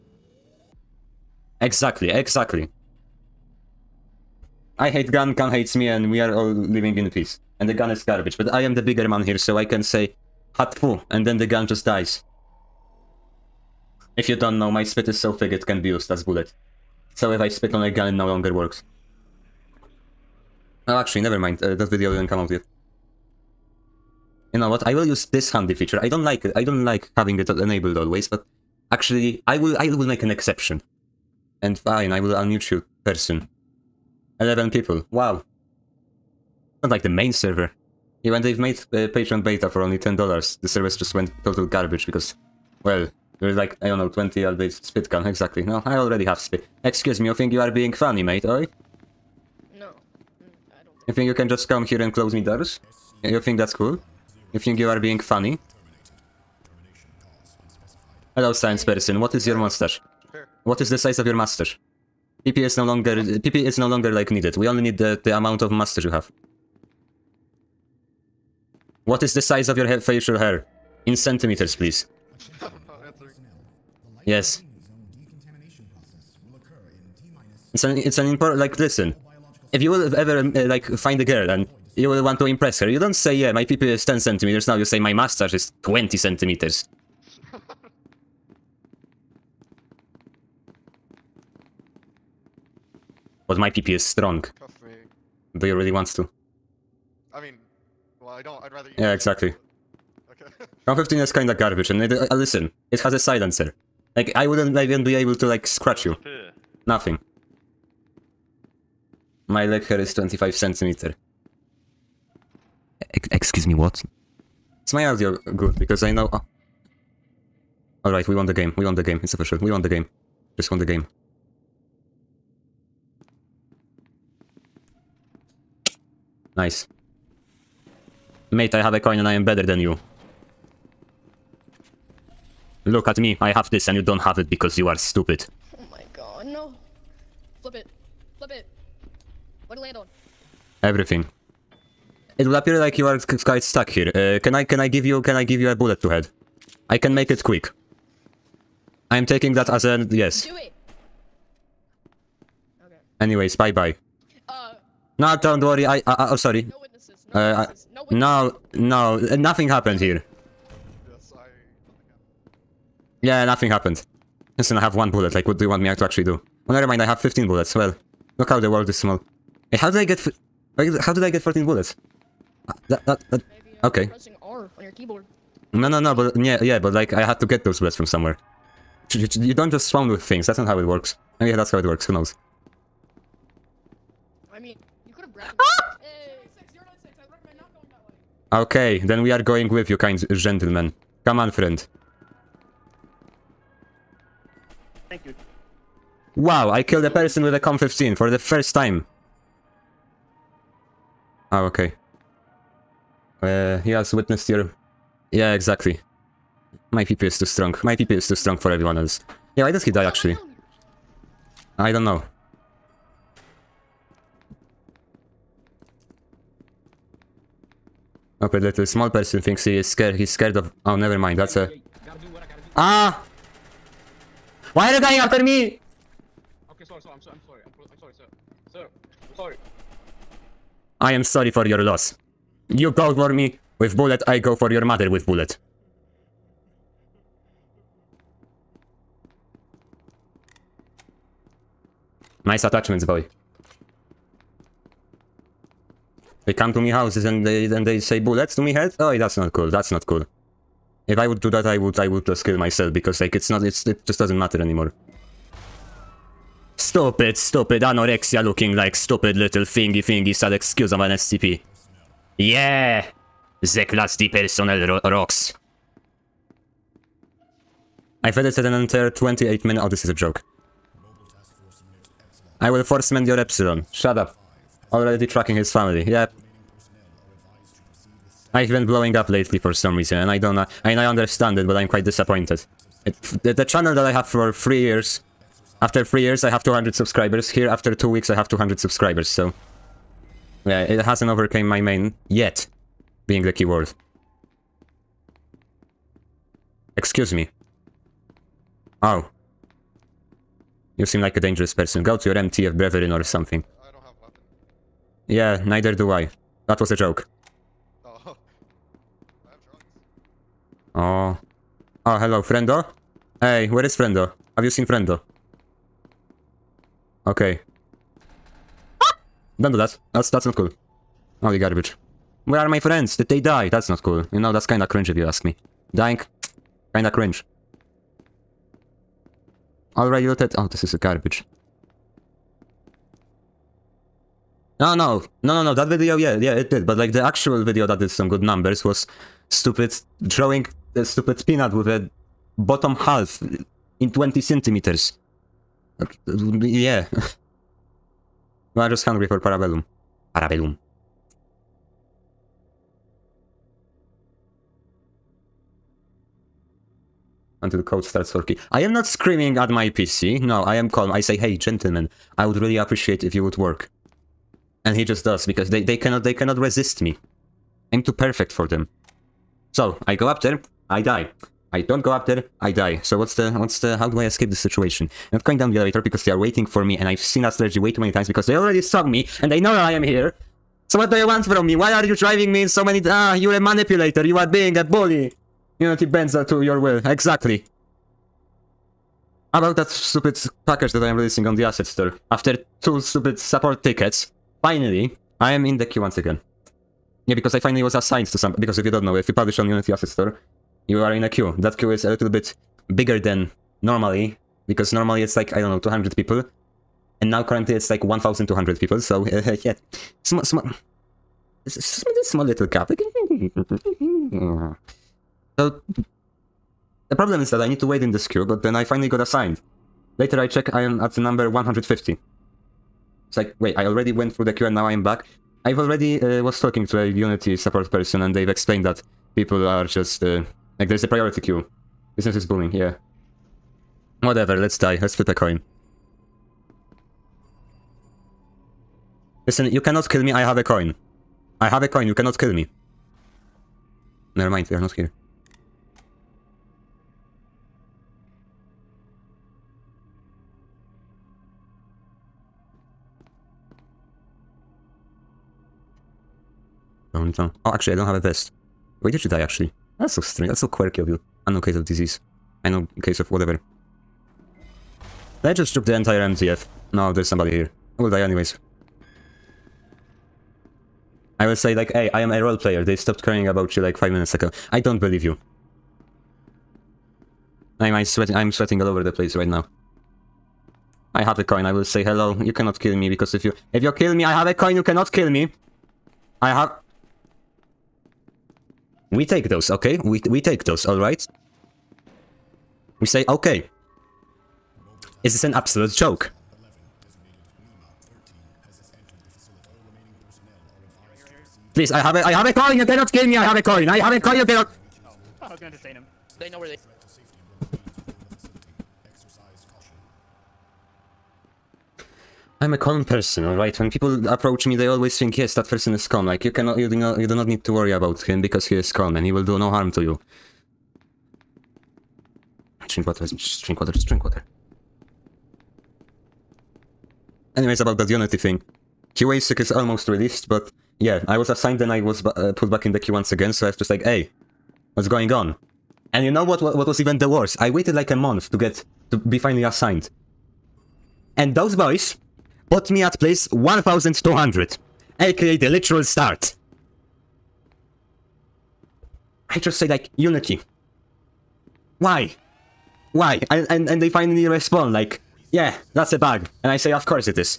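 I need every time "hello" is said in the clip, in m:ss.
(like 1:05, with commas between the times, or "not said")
0:58, 5:12, 8:02.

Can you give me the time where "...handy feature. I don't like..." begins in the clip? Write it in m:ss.
0:25.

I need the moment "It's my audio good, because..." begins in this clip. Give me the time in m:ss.
1:54.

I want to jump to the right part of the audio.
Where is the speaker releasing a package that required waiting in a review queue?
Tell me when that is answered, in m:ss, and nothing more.
6:39.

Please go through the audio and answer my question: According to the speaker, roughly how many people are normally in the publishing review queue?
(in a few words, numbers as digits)
200.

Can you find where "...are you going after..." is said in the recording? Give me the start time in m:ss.
3:44.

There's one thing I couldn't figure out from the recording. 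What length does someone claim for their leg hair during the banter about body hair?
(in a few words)
25 centimeters.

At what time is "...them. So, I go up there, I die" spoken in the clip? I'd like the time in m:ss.
6:08.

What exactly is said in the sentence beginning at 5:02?
Go to your MTF brethren or something.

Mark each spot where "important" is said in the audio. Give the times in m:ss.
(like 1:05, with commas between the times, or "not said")
1:18.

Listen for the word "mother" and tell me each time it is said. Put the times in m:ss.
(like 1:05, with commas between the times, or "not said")
3:54.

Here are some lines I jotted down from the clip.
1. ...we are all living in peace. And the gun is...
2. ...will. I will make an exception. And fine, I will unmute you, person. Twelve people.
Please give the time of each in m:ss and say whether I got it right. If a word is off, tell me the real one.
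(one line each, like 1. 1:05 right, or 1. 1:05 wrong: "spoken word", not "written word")
1. 0:06 right
2. 0:29 wrong: "Eleven", not "Twelve".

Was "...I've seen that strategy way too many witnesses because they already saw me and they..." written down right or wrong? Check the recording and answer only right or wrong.
wrong.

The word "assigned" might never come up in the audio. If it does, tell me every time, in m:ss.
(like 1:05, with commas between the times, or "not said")
6:37, 6:59, 8:51, 8:59.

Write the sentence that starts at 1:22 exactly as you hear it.
You don't say, yeah, my PP is 10 centimeters.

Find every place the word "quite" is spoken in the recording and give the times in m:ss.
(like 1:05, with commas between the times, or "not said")
2:23, 4:41.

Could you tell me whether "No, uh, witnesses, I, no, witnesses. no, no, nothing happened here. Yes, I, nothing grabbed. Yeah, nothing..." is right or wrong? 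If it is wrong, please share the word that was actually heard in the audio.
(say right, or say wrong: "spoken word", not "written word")
wrong: "happened", not "grabbed".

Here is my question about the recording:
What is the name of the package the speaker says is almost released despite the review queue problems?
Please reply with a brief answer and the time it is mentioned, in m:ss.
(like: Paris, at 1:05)
QASIC, at 8:49.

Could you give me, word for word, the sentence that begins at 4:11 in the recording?
If I would do that, I would I would just kill myself because like it's not it's it just doesn't matter anymore.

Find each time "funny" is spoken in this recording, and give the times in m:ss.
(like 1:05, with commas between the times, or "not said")
0:47, 0:55.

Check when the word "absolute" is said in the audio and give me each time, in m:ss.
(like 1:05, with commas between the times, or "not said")
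8:15.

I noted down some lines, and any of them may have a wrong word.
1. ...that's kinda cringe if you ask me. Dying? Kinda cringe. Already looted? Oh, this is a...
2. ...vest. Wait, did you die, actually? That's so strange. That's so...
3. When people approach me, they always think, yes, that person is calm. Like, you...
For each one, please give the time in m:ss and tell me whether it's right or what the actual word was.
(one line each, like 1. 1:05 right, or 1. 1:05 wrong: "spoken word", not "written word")
1. 5:24 right
2. 7:38 right
3. 8:33 right.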